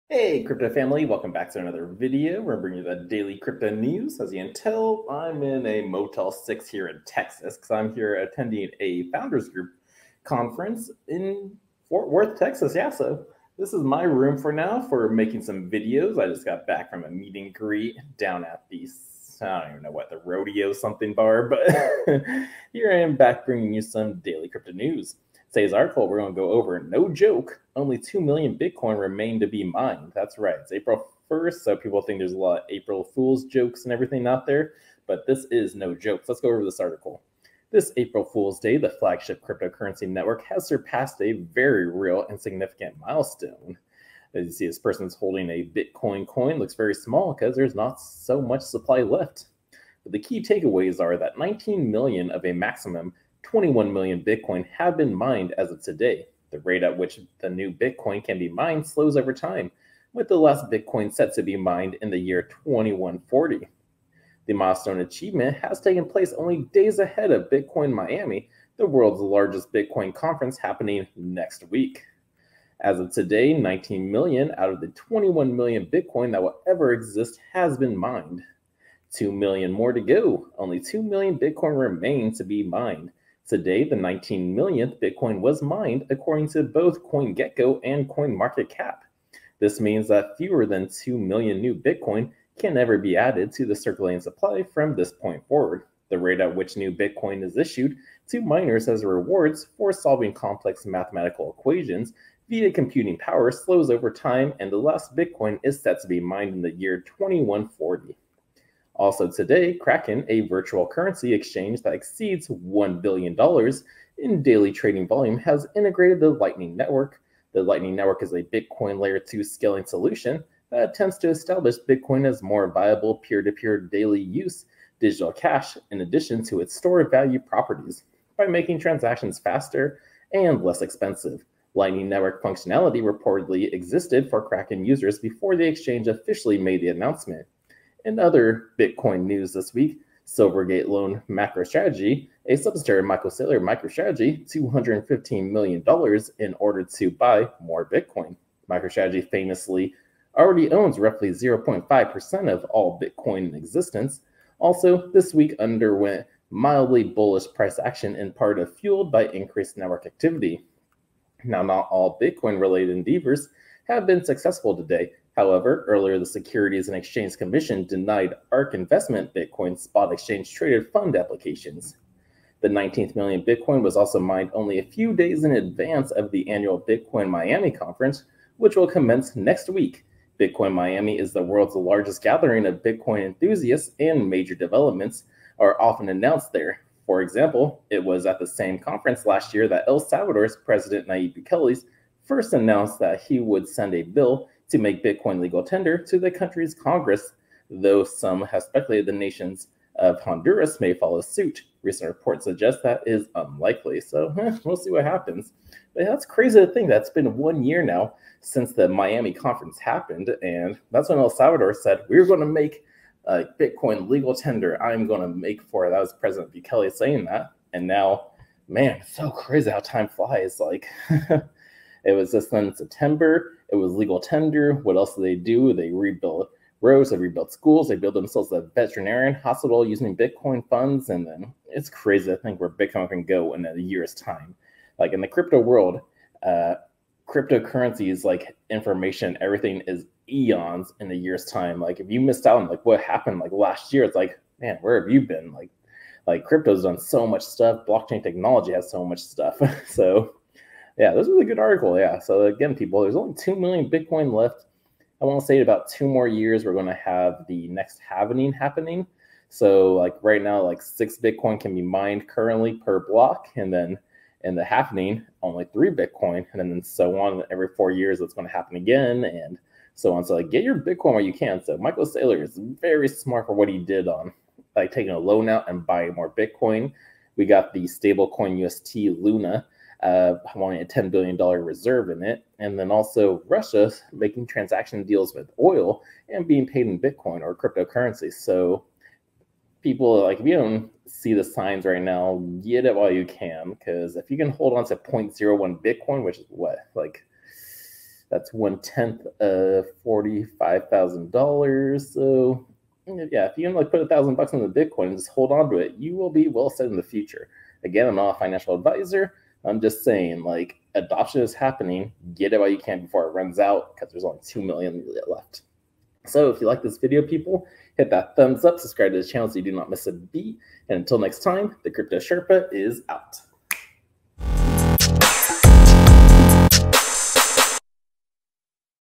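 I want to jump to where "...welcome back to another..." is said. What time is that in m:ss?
0:01.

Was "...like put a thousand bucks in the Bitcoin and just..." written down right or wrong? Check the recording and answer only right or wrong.
right.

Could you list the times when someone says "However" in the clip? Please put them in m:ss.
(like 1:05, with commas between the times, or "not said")
2:45.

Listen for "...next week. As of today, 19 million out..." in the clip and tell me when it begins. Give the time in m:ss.
1:11.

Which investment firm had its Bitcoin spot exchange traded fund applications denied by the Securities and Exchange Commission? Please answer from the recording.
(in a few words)
ARK Investment.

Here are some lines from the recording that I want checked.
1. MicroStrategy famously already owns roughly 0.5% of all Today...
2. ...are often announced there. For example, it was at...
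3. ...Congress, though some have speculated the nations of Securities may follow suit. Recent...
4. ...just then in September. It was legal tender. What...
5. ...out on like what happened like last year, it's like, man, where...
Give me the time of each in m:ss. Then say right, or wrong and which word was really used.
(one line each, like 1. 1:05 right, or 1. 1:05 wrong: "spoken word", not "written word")
1. 2:28 wrong: "Bitcoin", not "Today"
2. 3:05 right
3. 3:16 wrong: "Honduras", not "Securities"
4. 3:42 right
5. 4:02 right.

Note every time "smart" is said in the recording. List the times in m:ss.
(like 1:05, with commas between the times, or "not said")
4:33.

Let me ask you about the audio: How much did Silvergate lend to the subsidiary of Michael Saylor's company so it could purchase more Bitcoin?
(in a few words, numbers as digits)
$215 million.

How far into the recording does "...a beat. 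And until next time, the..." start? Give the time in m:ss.
5:20.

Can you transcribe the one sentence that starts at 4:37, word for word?
We got the stablecoin UST Luna uh, wanting a $10 billion reserve in it.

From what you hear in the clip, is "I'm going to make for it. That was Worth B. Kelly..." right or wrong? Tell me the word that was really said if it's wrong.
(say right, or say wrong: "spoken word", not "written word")
wrong: "President", not "Worth".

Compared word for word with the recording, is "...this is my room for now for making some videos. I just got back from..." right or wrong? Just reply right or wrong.
right.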